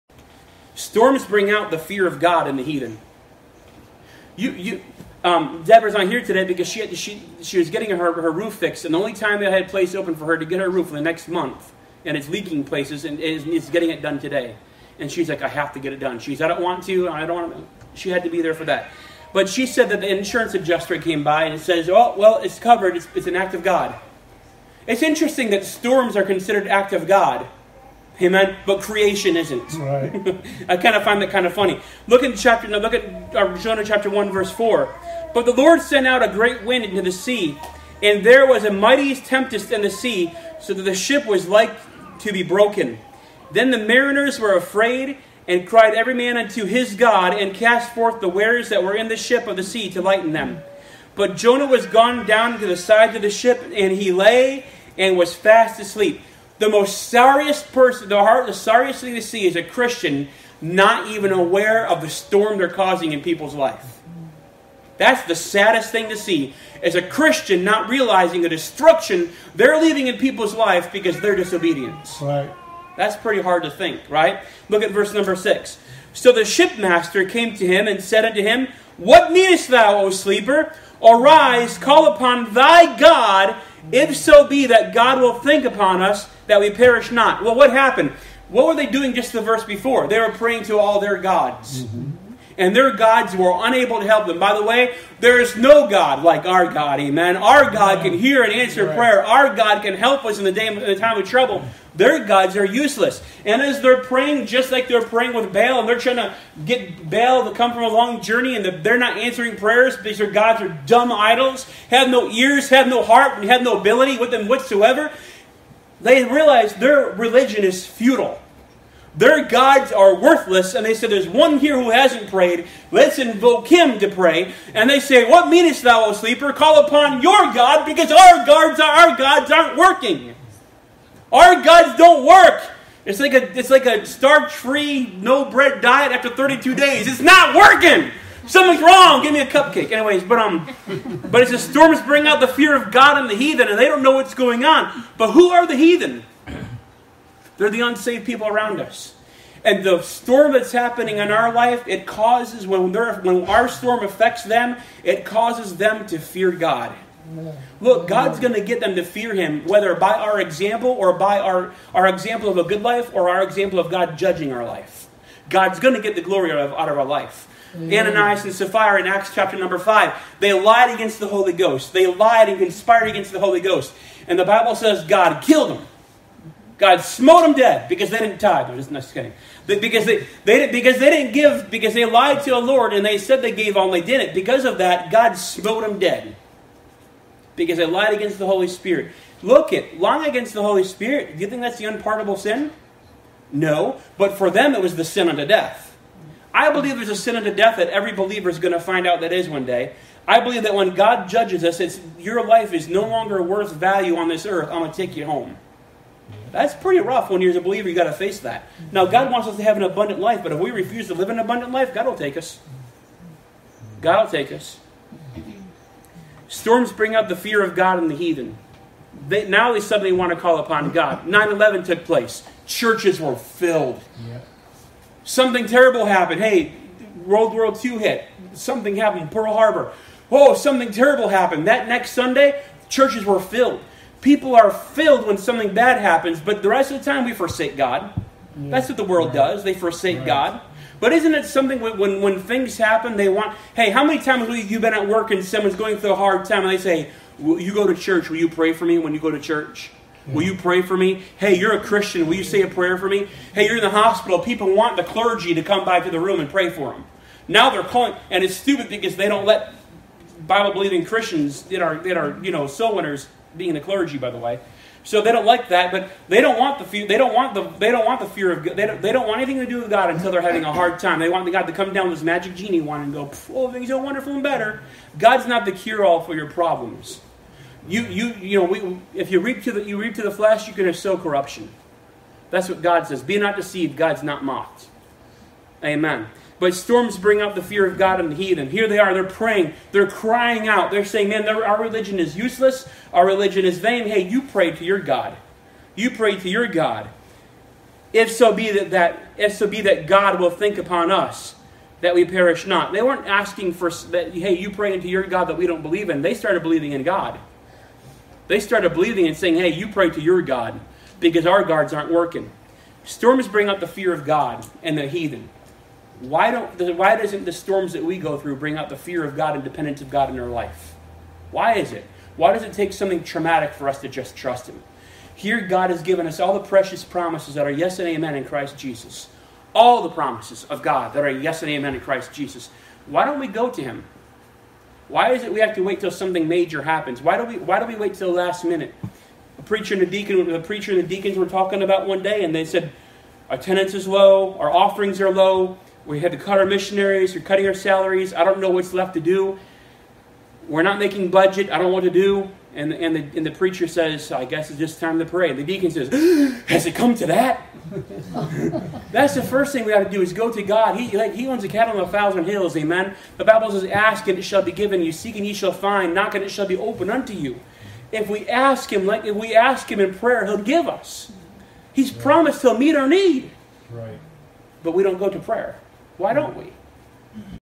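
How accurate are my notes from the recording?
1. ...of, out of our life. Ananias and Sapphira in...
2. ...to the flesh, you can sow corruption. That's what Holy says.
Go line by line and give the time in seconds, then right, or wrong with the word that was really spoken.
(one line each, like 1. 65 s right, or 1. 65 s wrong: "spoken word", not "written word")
1. 166 s right
2. 280 s wrong: "God", not "Holy".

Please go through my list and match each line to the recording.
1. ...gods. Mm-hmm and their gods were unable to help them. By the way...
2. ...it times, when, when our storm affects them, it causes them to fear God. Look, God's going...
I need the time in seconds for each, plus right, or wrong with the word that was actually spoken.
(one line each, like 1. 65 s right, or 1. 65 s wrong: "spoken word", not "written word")
1. 91 s right
2. 151 s wrong: "causes", not "times".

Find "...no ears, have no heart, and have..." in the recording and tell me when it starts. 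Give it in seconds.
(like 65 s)
112 s.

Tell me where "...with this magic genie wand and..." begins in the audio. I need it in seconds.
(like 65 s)
272 s.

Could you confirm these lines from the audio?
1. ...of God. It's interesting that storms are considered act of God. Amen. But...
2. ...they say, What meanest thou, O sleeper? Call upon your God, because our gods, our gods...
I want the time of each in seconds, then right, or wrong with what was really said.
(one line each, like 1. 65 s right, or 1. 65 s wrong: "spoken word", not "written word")
1. 23 s right
2. 124 s right.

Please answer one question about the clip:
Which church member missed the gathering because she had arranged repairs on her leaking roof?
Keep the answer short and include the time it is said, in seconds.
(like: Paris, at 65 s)
Deborah, at 5 s.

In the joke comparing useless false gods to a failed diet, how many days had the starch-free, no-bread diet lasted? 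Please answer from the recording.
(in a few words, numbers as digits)
32.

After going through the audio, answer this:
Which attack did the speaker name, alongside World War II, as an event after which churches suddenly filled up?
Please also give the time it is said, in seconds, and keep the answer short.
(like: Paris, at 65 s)
Pearl Harbor, at 229 s.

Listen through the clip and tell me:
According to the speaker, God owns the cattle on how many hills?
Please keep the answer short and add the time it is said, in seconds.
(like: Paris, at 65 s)
1000, at 362 s.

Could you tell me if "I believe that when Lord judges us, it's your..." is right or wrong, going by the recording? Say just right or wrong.
wrong.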